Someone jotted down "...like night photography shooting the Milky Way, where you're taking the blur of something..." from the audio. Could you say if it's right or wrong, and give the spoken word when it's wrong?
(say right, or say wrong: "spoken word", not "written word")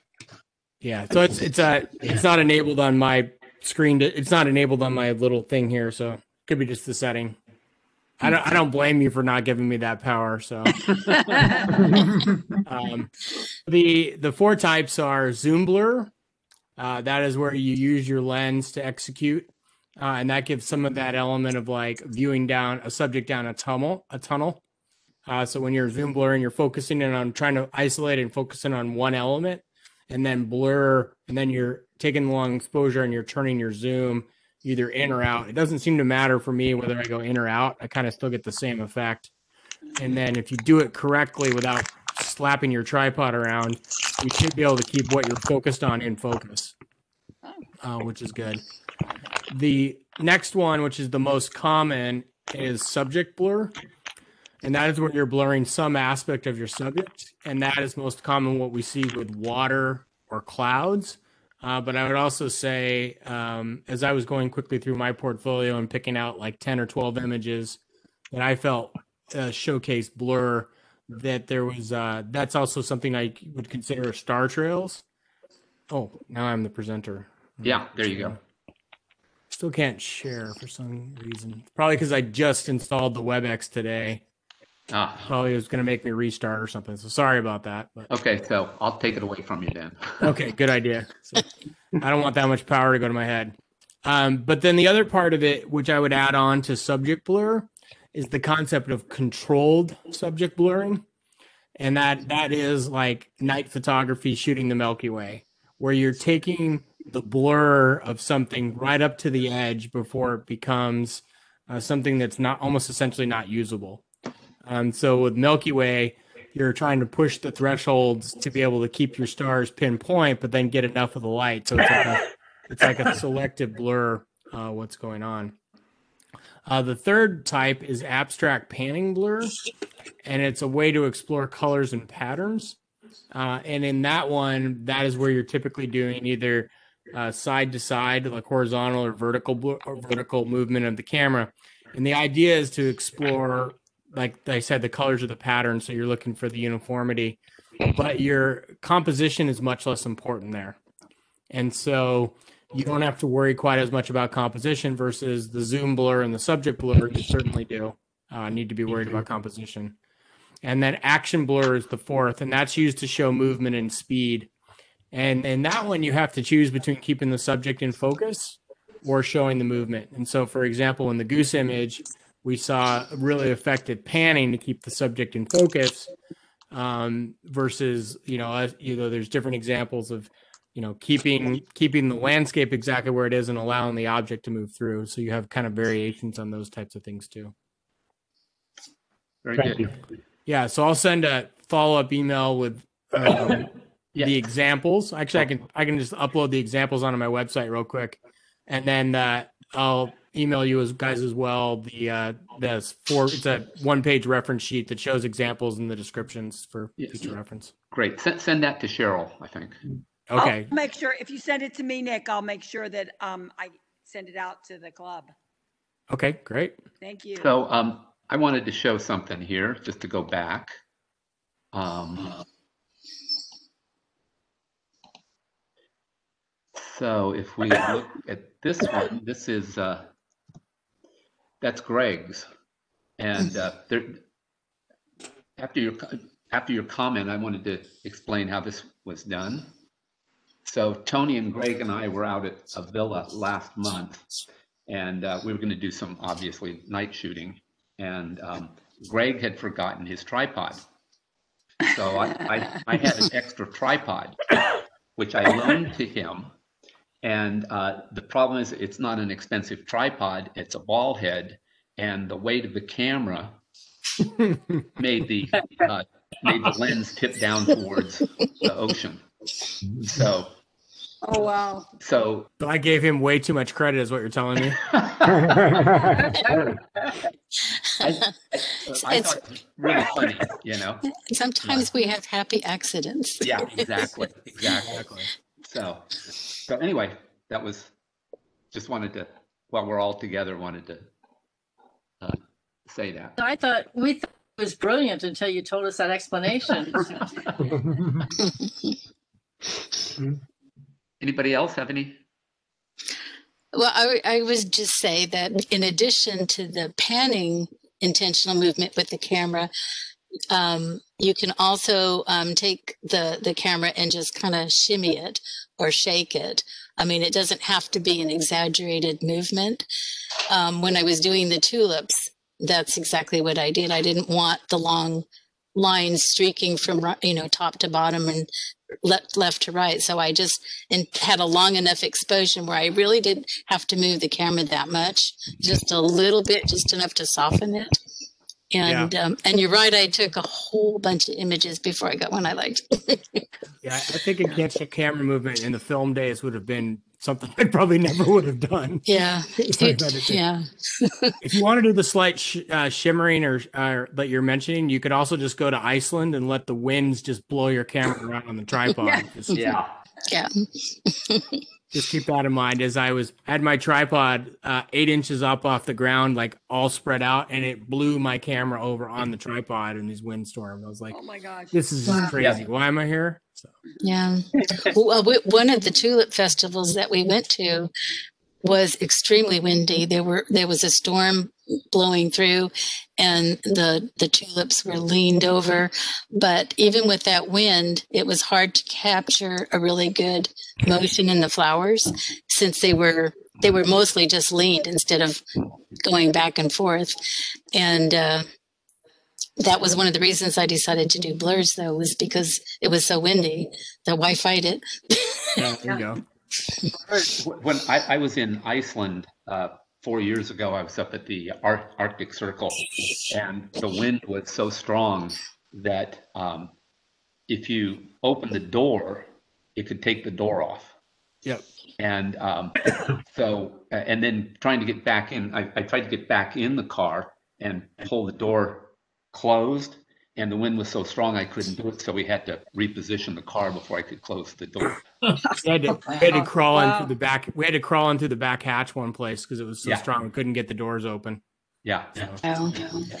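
right.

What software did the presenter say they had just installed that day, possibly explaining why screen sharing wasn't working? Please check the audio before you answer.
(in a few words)
WebEx.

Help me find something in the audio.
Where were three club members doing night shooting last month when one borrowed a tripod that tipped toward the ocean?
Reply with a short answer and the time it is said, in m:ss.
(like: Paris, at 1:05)
Avila, at 4:02.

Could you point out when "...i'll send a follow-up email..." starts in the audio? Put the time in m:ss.
3:10.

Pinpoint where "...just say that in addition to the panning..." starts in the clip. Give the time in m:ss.
5:04.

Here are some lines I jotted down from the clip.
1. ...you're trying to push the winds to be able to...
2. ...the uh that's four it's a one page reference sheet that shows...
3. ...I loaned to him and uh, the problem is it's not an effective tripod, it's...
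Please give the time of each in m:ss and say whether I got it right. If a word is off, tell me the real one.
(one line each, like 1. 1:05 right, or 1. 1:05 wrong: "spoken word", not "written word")
1. 1:56 wrong: "thresholds", not "winds"
2. 3:21 right
3. 4:15 wrong: "expensive", not "effective".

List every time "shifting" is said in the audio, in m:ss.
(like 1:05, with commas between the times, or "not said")
not said.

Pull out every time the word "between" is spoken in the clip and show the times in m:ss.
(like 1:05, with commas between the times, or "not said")
2:46.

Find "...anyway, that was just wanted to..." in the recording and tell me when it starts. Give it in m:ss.
4:46.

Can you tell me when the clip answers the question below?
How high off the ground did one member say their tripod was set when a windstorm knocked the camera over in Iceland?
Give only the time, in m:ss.
6:04.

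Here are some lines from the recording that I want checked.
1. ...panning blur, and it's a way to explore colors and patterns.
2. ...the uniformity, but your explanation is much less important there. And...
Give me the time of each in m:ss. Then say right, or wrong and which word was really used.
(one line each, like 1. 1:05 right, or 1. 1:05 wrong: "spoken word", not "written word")
1. 2:08 right
2. 2:26 wrong: "composition", not "explanation".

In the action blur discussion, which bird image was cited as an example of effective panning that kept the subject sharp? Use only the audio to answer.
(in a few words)
Goose.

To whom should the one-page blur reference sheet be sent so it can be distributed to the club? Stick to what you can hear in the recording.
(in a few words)
Cheryl.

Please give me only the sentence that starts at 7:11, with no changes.
So we had to reposition the car before I could close the door.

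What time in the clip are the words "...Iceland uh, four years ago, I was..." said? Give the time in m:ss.
6:48.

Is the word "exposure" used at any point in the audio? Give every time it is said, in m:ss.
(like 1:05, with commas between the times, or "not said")
0:32, 5:32.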